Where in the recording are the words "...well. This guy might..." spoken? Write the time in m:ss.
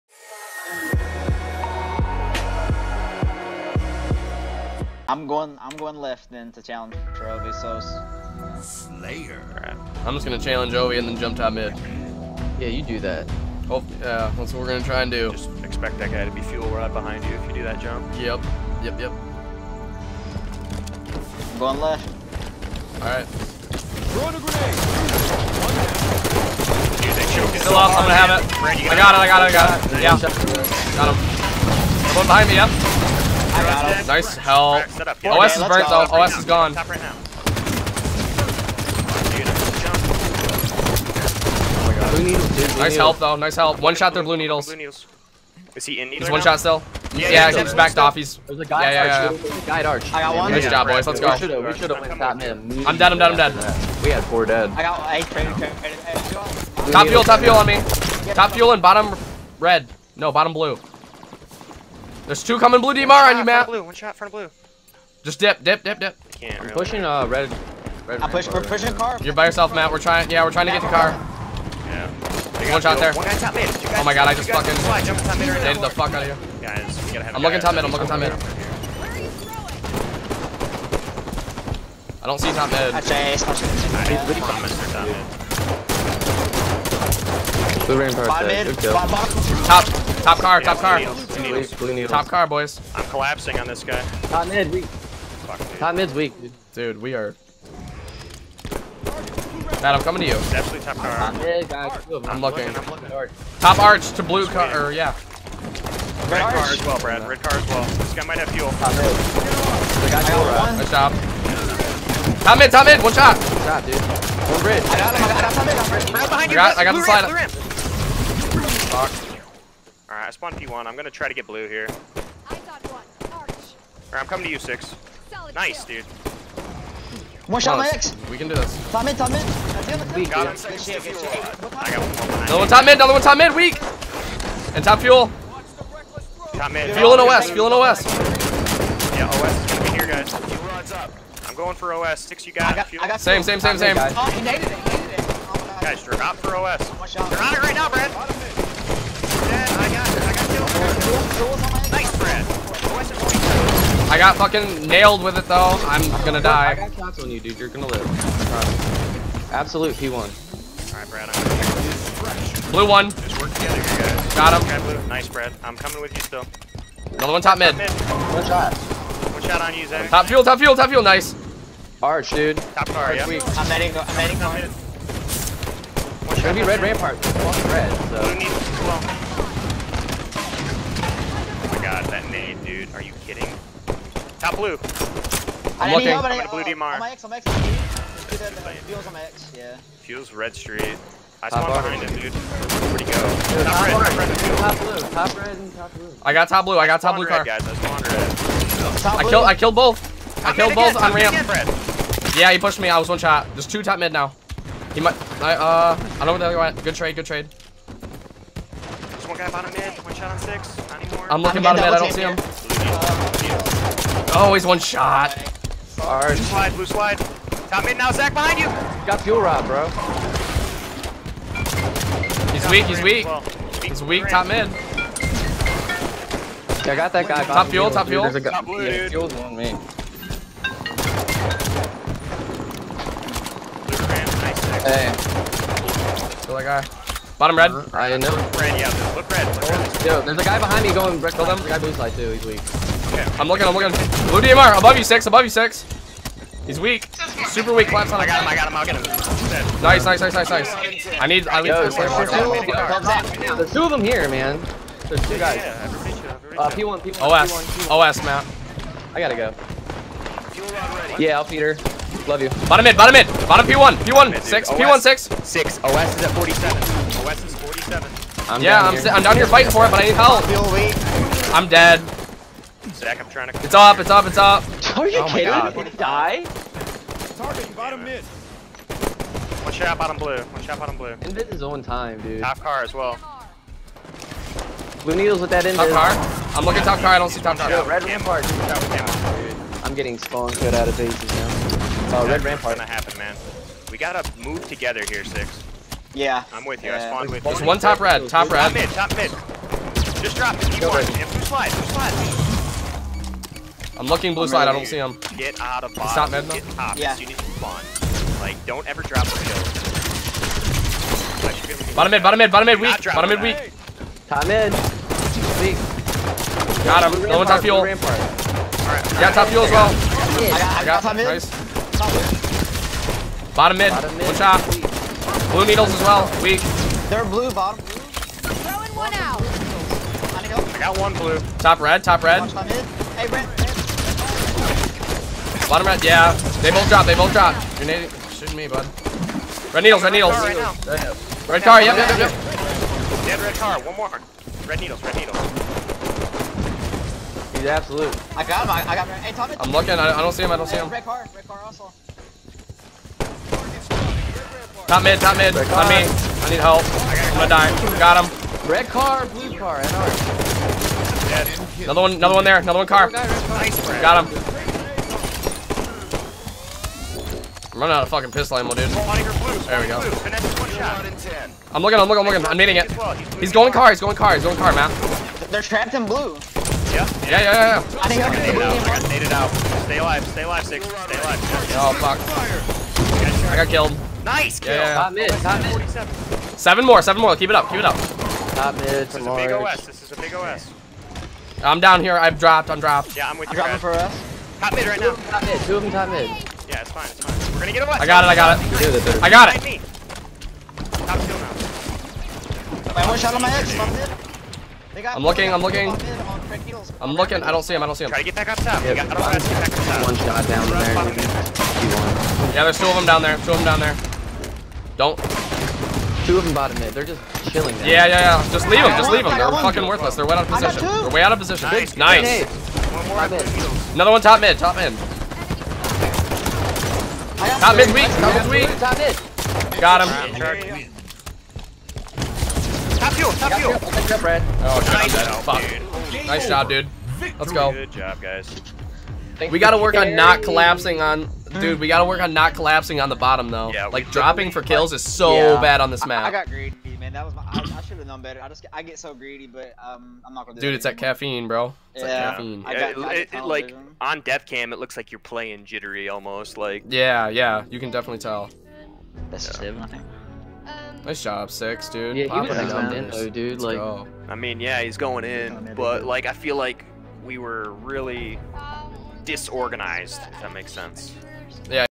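1:47.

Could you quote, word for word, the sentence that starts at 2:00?
I'm gonna try to get blue here.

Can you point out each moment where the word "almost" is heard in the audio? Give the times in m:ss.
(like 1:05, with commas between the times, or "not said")
7:36.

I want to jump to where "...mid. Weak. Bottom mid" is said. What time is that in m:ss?
5:12.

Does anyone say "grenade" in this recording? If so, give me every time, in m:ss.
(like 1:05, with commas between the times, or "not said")
0:24.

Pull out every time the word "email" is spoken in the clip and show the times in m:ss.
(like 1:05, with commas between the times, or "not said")
not said.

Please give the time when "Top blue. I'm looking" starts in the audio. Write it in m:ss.
3:04.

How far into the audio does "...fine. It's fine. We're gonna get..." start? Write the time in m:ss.
6:36.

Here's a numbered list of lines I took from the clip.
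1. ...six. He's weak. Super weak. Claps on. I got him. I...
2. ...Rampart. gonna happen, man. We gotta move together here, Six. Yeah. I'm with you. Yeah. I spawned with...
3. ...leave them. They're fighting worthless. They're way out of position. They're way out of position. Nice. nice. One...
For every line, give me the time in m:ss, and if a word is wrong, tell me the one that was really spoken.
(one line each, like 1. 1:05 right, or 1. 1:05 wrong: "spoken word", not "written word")
1. 4:05 right
2. 4:52 right
3. 6:59 wrong: "fucking", not "fighting".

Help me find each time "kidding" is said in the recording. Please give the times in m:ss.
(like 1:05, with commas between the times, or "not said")
3:03, 4:35.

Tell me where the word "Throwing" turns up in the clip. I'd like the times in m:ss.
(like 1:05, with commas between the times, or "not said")
0:24, 5:28.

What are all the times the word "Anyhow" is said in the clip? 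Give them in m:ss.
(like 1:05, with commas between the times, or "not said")
not said.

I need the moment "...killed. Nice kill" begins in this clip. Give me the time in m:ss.
6:23.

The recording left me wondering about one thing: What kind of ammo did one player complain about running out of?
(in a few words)
pistol ammo.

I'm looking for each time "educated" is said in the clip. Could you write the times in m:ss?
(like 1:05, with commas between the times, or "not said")
not said.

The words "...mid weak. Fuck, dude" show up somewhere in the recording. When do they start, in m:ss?
1:34.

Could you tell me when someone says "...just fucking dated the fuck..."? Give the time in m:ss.
1:14.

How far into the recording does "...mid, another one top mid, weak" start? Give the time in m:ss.
2:12.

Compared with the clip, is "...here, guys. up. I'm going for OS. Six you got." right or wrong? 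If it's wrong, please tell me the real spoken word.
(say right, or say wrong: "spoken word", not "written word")
right.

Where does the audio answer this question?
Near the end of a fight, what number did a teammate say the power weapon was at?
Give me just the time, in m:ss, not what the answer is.
4:26.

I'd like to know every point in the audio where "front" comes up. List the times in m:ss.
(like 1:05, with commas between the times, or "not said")
1:04.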